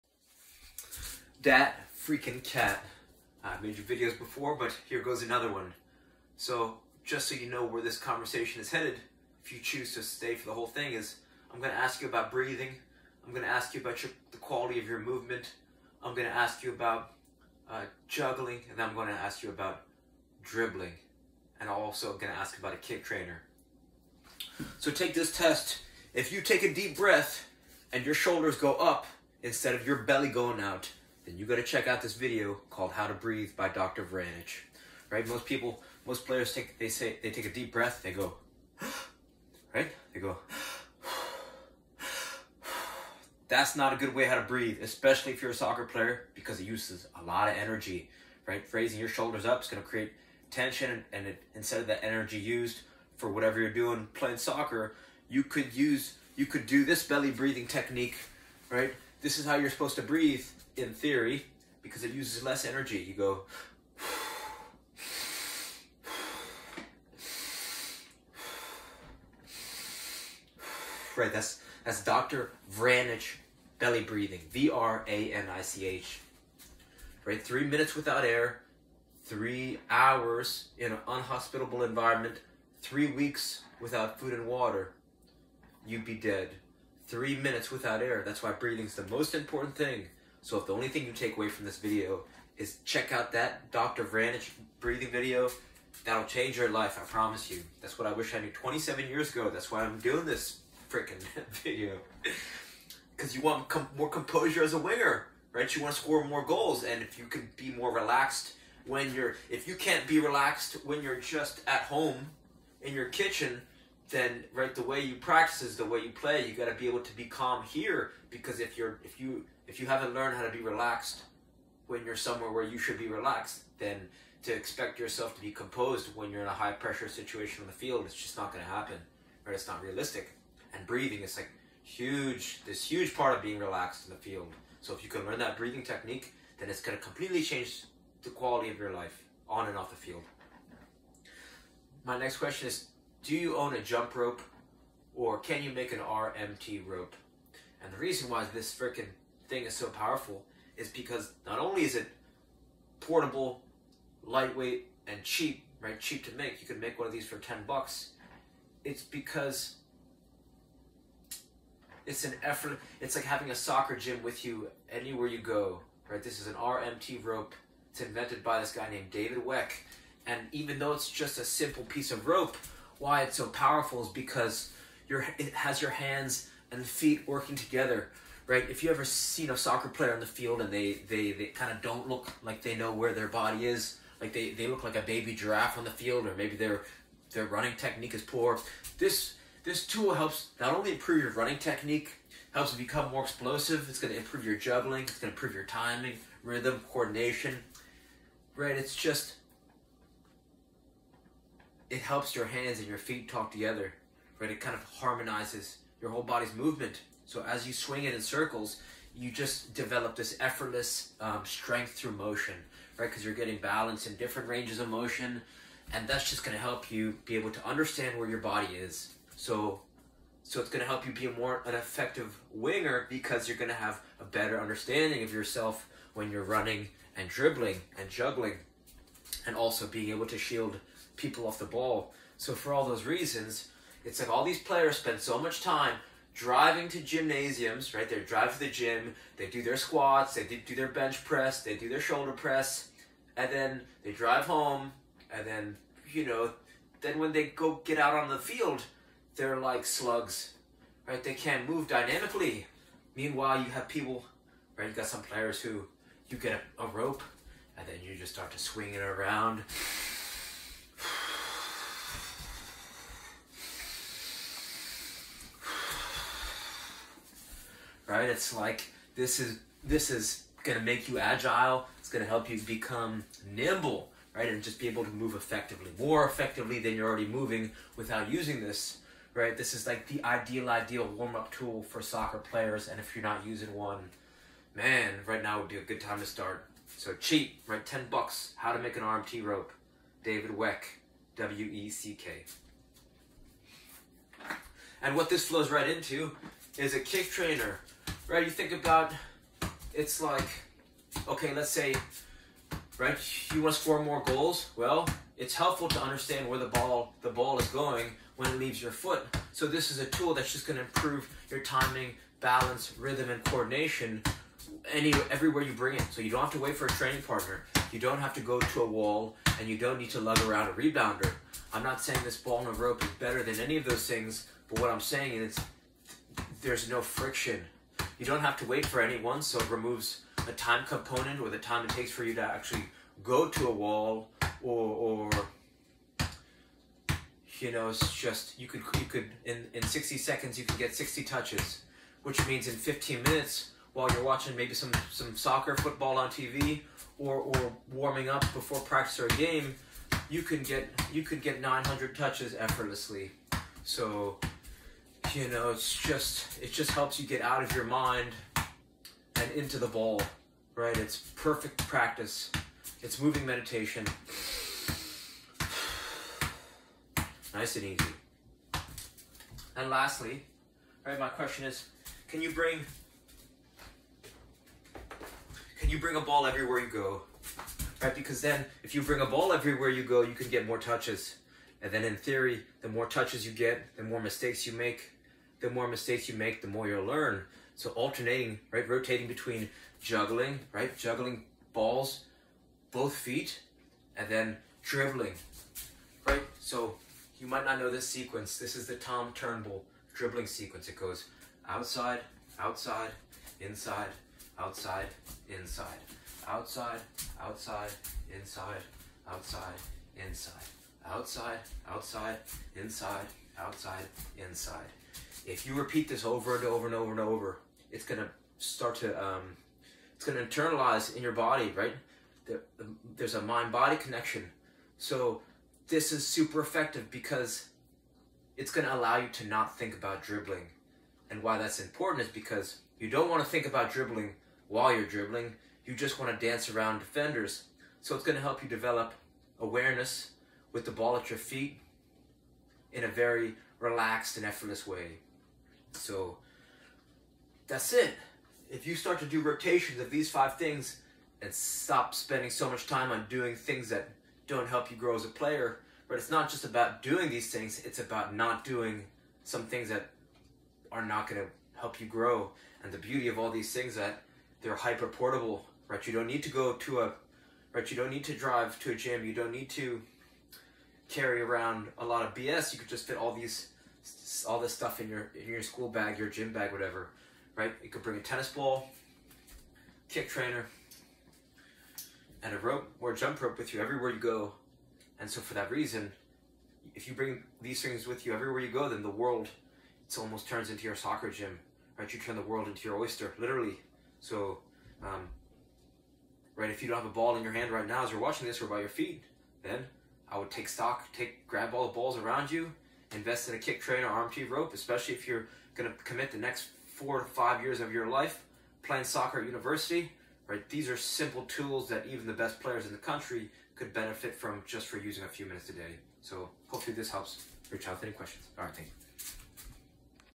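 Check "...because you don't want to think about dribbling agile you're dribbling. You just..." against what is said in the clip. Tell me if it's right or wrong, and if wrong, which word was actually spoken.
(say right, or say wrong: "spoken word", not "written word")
wrong: "while", not "agile".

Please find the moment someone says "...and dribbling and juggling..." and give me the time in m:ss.
3:47.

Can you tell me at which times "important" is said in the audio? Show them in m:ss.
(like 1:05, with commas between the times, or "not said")
1:29, 7:11.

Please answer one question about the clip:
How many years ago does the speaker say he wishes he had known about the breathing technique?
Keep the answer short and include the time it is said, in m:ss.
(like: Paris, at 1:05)
27, at 1:38.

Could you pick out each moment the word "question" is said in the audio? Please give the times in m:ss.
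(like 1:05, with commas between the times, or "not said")
2:22, 6:11, 8:38.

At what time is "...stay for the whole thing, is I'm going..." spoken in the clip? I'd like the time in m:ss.
0:10.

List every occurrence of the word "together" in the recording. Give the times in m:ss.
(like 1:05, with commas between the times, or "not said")
2:57, 3:23.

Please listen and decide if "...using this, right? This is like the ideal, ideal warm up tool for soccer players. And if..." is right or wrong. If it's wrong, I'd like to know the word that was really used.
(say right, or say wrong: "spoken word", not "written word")
right.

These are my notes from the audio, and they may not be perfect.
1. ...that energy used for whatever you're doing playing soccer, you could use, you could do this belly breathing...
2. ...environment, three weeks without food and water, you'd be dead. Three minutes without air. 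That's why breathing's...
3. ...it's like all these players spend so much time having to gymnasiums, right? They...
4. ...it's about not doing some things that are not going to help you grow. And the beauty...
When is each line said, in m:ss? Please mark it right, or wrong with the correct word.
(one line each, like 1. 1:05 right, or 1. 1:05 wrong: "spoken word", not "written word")
1. 0:51 right
2. 1:21 right
3. 3:54 wrong: "driving", not "having"
4. 7:37 right.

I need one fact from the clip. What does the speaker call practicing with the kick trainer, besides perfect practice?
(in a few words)
moving meditation.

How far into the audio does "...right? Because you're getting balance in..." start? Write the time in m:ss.
3:32.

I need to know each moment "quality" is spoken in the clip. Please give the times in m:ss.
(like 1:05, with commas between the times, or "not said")
0:14, 2:18.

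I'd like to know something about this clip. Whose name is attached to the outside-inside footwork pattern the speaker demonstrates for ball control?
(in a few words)
Tom Turnbull.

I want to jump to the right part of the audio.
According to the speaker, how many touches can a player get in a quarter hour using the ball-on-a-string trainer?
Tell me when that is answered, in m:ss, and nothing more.
5:51.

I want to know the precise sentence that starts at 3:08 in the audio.
This this tool helps not only improve your running technique, helps you become more explosive.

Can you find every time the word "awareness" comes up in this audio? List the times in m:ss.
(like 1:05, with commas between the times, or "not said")
7:19.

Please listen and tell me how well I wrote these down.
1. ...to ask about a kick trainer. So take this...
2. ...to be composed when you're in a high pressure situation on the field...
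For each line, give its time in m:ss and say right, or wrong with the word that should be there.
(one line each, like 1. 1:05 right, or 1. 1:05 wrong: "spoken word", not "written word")
1. 0:22 right
2. 2:05 right.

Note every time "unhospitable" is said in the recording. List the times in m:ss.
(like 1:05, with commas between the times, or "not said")
1:21.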